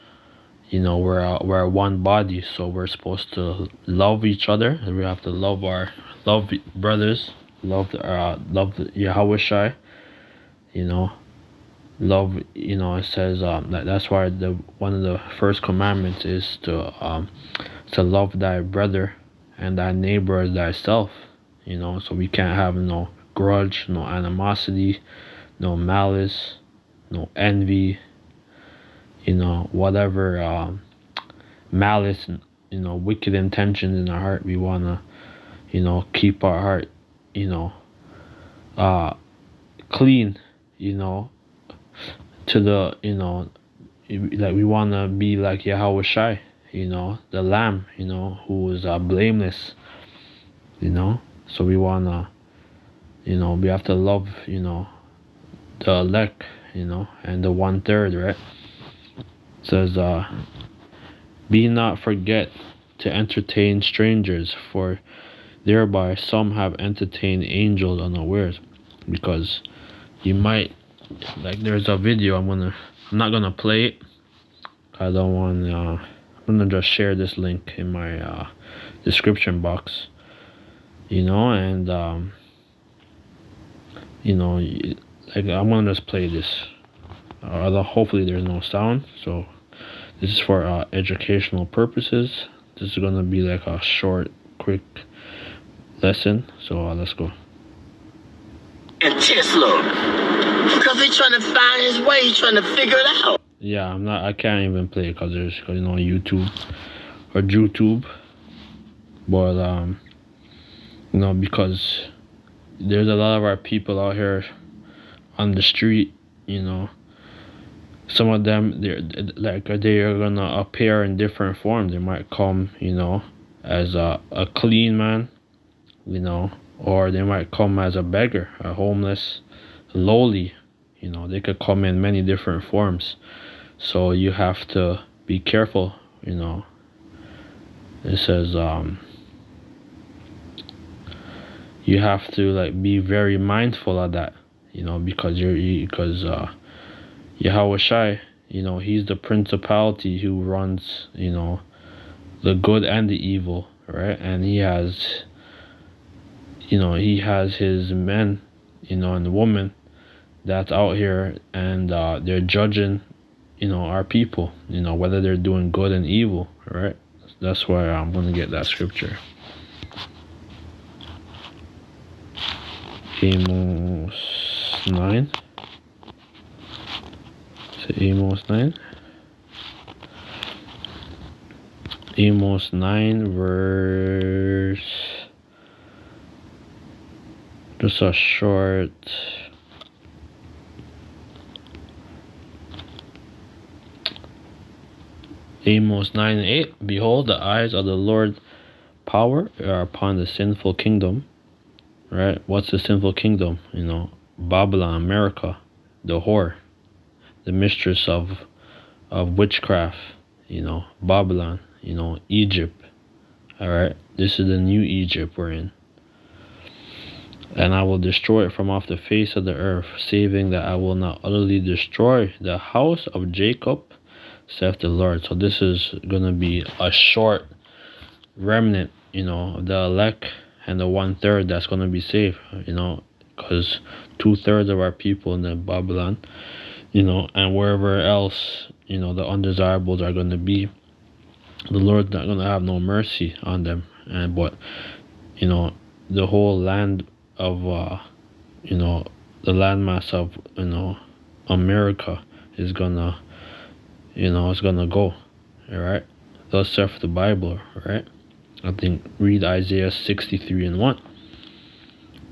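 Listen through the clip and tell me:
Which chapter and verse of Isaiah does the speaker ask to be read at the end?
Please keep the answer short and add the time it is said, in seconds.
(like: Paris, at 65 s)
Isaiah 63:1, at 259 s.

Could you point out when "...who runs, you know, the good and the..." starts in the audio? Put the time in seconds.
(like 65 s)
150 s.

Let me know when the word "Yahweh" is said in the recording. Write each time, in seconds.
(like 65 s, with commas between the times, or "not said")
8 s, 45 s, 147 s.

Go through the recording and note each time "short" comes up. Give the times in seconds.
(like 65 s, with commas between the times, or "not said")
93 s, 188 s, 226 s.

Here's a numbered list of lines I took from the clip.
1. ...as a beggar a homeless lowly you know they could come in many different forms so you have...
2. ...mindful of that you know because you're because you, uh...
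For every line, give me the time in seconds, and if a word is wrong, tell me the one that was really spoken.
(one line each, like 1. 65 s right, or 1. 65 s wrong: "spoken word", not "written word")
1. 127 s right
2. 143 s right.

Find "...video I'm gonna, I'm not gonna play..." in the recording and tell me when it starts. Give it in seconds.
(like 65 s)
71 s.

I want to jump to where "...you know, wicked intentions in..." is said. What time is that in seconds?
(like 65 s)
32 s.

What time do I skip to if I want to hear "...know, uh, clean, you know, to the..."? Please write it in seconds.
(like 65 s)
37 s.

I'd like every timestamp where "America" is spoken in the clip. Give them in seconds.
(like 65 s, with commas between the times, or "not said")
204 s, 251 s.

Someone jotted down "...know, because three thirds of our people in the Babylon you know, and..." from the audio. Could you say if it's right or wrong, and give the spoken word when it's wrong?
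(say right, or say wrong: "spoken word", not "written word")
wrong: "two", not "three".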